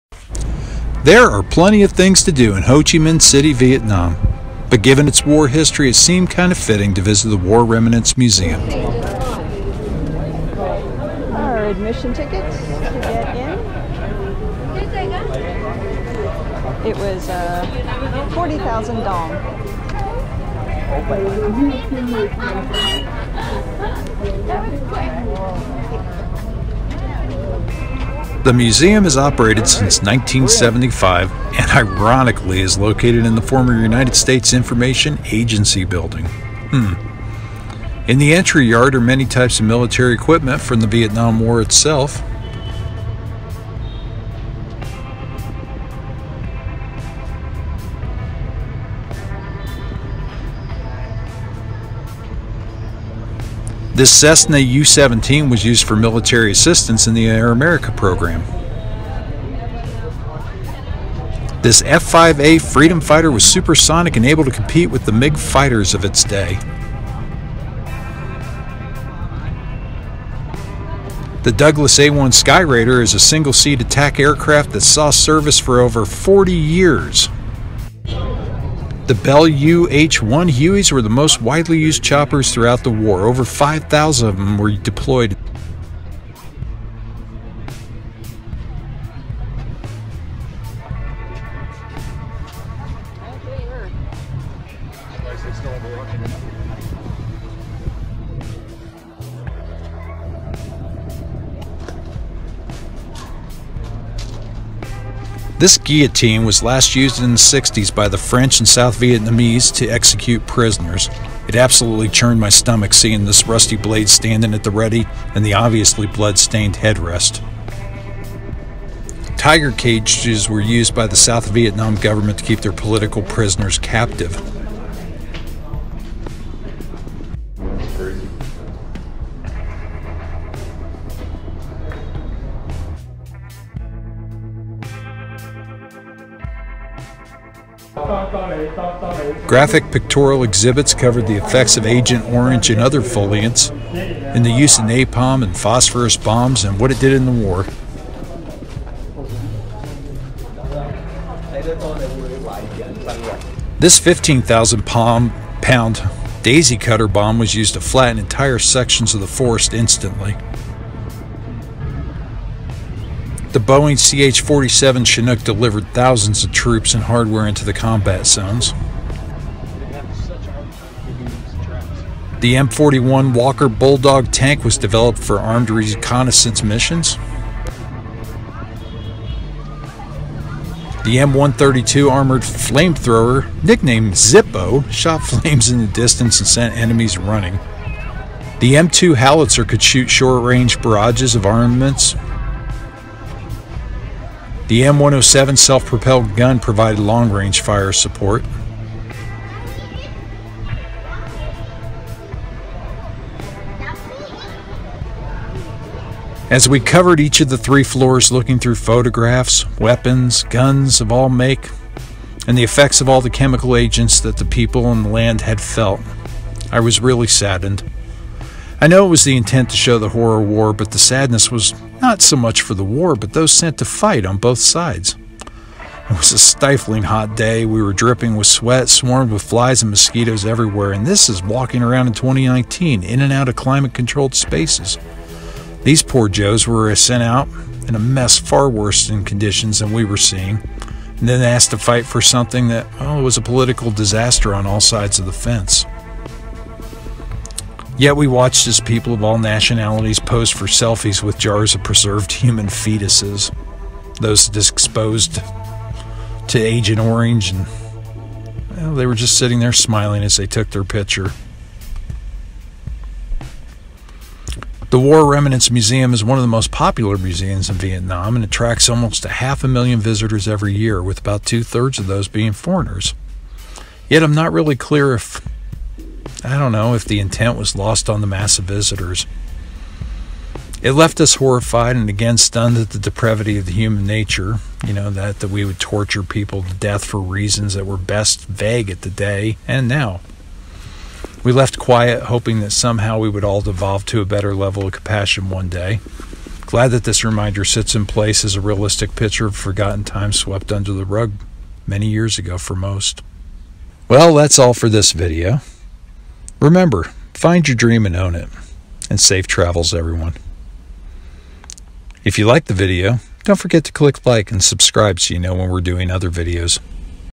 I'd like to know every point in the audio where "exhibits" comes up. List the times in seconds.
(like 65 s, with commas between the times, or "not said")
140 s.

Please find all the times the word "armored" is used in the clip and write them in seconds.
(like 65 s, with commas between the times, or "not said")
182 s.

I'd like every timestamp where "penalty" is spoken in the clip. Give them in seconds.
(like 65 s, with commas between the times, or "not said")
not said.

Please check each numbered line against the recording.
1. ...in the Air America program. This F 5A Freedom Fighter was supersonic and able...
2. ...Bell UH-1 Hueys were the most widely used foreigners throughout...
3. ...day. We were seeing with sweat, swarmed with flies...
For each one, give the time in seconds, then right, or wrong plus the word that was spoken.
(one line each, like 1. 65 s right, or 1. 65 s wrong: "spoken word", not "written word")
1. 57 s right
2. 79 s wrong: "choppers", not "foreigners"
3. 227 s wrong: "dripping", not "seeing".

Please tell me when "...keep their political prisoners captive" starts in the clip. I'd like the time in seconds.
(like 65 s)
122 s.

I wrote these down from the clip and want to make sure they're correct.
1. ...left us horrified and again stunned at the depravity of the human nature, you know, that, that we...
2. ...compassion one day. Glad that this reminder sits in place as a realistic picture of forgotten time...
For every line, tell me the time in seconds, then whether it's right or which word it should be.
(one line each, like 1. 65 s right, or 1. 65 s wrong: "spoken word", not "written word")
1. 280 s right
2. 294 s right.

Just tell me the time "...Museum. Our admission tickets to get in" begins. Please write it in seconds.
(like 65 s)
8 s.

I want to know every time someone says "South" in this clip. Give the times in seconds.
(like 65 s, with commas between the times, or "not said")
108 s, 121 s.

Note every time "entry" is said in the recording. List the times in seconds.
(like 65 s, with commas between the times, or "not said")
38 s.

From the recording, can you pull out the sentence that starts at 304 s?
Well, that's all for this video.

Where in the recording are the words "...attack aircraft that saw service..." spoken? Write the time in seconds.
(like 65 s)
73 s.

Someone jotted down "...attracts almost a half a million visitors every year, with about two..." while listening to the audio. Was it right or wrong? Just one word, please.
right.